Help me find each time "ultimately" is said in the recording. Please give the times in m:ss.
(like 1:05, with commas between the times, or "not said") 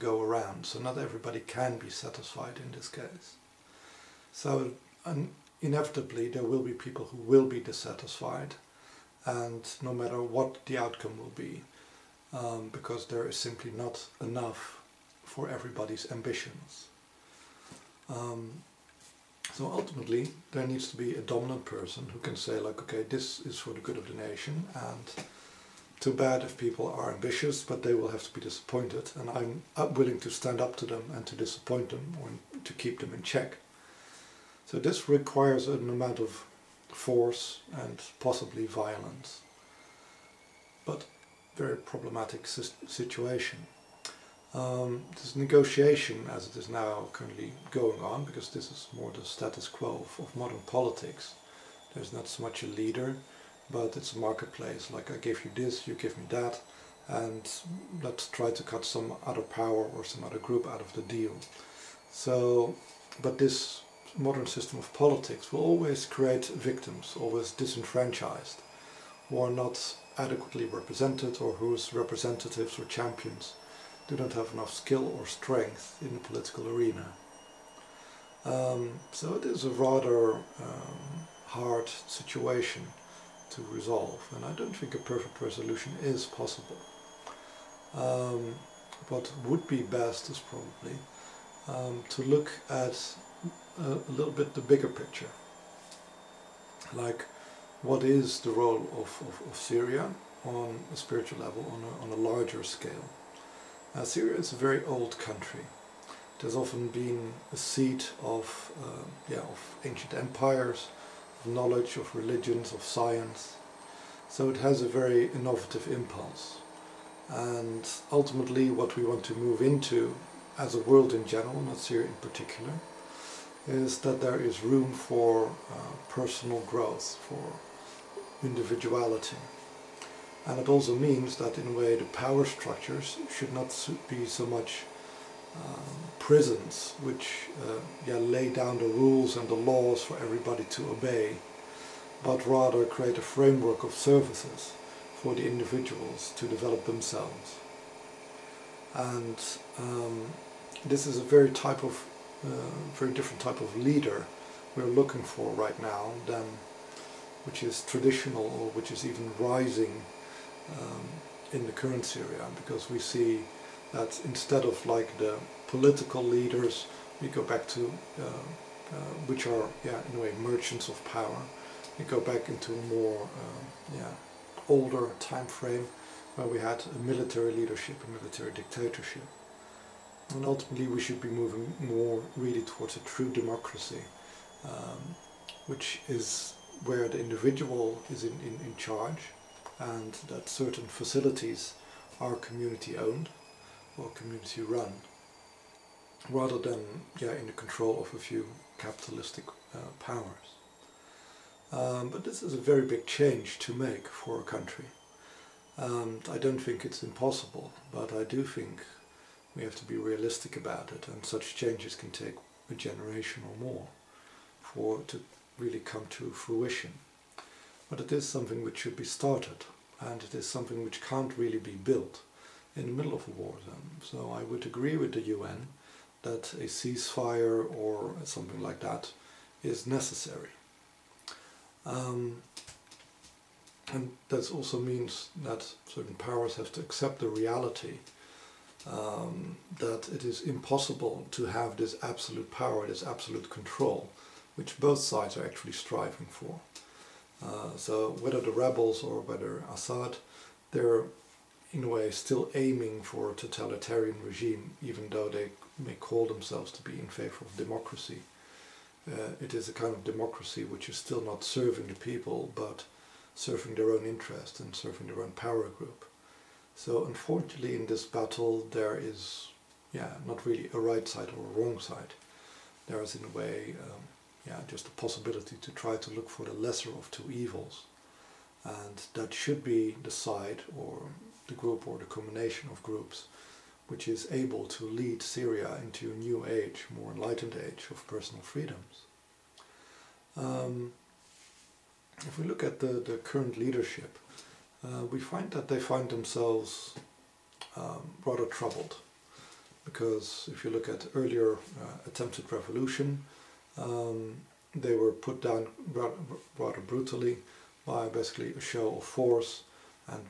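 0:19, 1:58, 3:00.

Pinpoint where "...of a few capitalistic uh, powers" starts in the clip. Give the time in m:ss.
3:18.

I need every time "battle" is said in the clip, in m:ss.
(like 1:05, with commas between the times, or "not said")
4:28.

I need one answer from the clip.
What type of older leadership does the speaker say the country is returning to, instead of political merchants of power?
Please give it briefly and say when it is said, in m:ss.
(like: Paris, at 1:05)
military dictatorship, at 2:58.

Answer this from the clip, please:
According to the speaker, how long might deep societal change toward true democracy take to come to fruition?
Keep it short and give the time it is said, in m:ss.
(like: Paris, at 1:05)
a generation or more, at 3:32.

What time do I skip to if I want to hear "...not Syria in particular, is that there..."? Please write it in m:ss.
2:01.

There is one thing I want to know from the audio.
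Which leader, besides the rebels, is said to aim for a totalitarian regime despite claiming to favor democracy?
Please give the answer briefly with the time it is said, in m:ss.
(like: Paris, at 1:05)
Assad, at 4:09.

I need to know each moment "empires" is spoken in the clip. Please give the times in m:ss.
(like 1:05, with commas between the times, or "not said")
1:50.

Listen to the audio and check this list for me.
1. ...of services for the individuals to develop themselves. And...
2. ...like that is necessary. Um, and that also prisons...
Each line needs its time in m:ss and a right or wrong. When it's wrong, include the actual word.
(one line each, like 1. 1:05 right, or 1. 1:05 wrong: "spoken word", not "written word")
1. 2:23 right
2. 3:48 wrong: "means", not "prisons".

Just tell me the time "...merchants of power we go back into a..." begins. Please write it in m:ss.
2:50.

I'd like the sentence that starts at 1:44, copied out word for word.
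Syria is a very old country.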